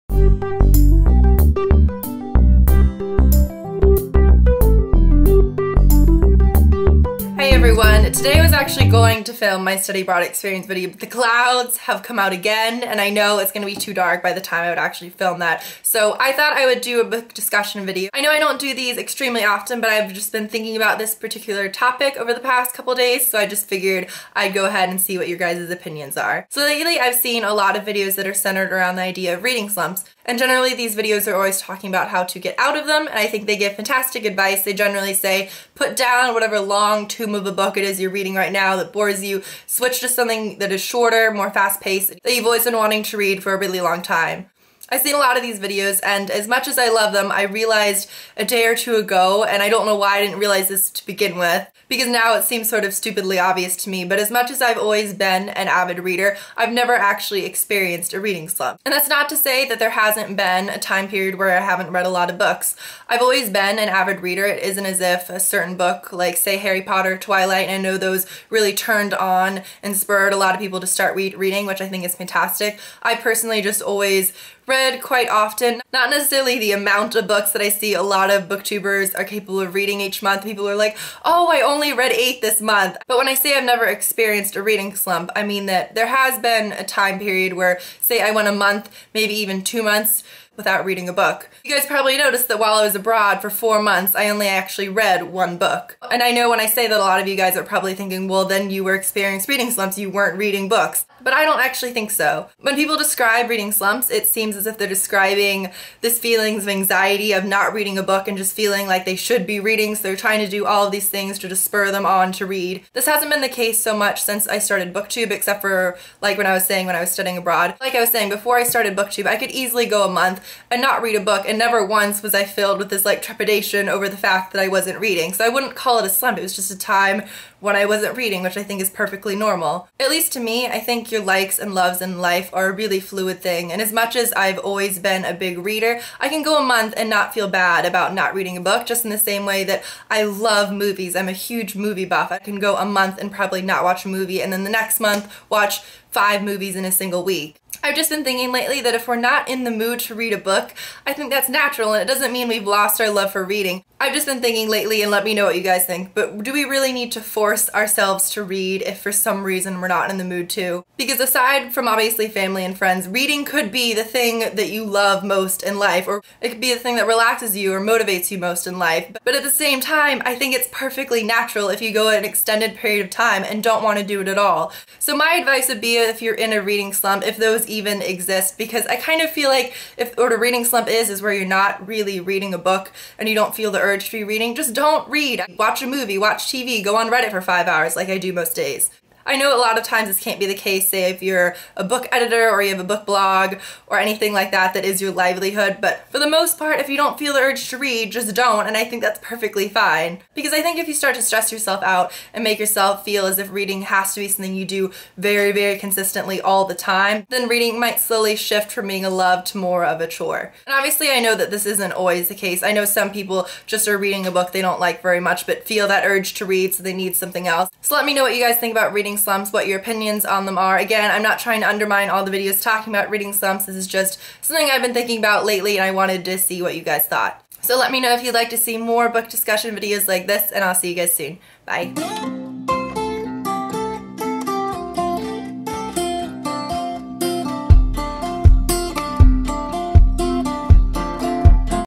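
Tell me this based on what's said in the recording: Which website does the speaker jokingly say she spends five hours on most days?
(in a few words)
Reddit.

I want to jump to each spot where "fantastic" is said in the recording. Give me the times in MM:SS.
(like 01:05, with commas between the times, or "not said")
00:33, 01:12.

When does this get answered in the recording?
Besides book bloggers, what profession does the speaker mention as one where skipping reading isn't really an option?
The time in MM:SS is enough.
03:11.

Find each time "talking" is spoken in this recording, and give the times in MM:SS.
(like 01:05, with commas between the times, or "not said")
00:31, 03:42.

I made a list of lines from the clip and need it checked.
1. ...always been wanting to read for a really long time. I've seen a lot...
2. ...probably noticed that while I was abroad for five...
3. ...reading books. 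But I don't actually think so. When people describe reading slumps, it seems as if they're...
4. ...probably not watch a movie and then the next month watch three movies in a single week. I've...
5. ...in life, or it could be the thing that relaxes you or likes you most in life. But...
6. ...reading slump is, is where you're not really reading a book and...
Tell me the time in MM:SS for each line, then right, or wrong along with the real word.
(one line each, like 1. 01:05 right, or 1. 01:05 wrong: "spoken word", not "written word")
1. 00:42 right
2. 01:31 wrong: "four", not "five"
3. 01:40 right
4. 02:23 wrong: "five", not "three"
5. 02:45 wrong: "motivates", not "likes"
6. 03:00 right.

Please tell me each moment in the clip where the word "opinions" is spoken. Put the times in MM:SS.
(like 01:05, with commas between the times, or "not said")
00:25, 03:39.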